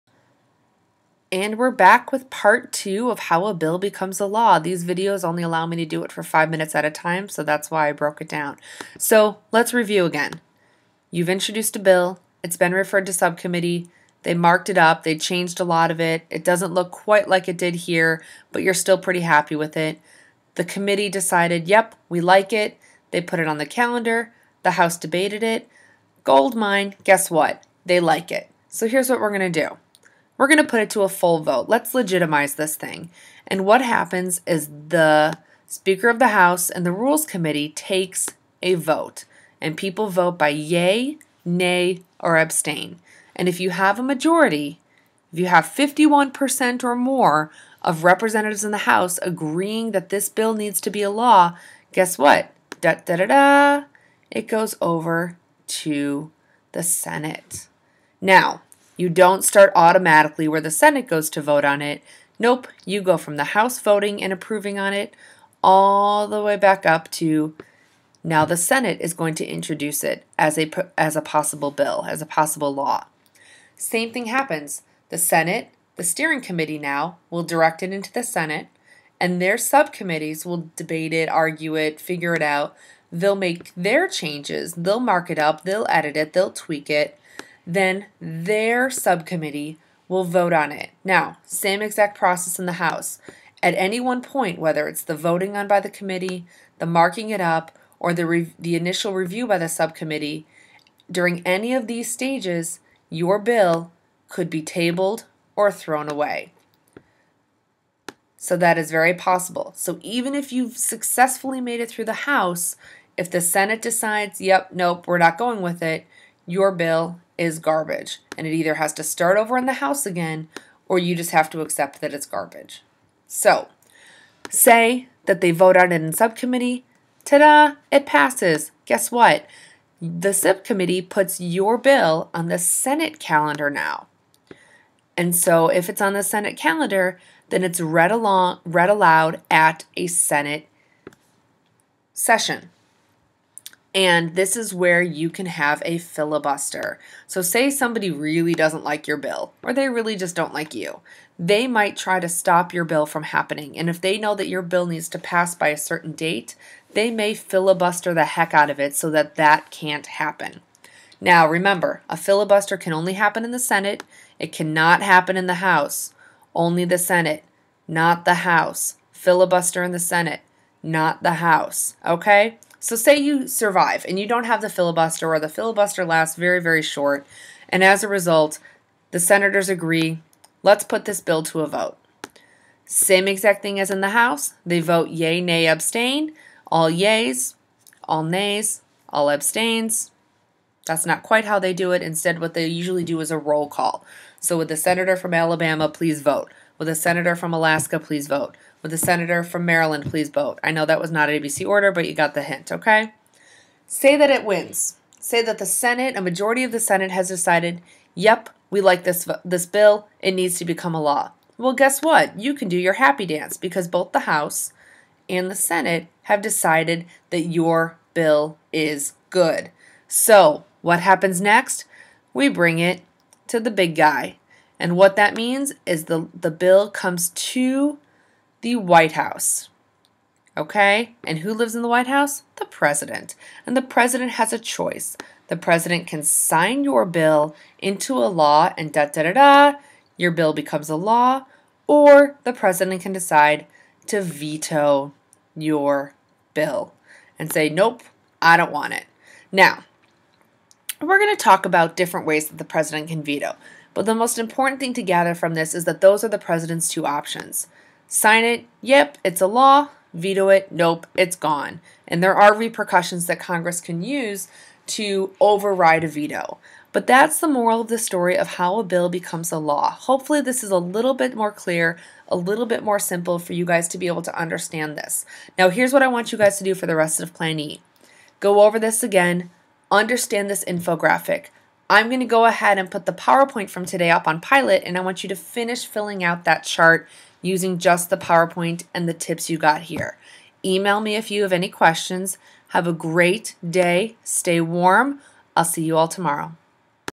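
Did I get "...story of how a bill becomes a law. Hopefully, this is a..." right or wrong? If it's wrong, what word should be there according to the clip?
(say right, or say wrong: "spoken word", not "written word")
right.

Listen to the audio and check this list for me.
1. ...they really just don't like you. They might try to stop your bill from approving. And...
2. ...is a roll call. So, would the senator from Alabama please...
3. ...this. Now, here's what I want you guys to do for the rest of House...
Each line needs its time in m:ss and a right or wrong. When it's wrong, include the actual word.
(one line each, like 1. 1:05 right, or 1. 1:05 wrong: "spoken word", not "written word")
1. 2:29 wrong: "happening", not "approving"
2. 3:13 right
3. 4:34 wrong: "Plan", not "House".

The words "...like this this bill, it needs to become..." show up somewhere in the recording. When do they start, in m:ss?
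3:28.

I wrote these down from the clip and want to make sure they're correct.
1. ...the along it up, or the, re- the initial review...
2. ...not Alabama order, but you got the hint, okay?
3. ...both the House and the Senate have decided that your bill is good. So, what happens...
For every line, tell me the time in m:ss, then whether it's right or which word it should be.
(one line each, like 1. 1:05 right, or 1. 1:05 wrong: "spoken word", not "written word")
1. 1:36 wrong: "marking", not "along"
2. 3:21 wrong: "ABC", not "Alabama"
3. 3:33 right.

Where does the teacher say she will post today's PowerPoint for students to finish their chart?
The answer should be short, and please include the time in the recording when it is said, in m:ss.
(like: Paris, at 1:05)
Pilot, at 4:44.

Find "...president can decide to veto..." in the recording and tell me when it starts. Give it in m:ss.
4:02.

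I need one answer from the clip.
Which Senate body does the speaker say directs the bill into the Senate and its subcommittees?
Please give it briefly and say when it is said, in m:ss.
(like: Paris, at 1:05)
the steering committee, at 1:15.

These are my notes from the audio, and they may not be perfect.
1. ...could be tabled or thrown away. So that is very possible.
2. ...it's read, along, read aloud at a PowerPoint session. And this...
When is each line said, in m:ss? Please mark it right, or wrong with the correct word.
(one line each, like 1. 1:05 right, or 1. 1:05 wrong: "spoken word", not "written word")
1. 1:44 right
2. 2:17 wrong: "Senate", not "PowerPoint".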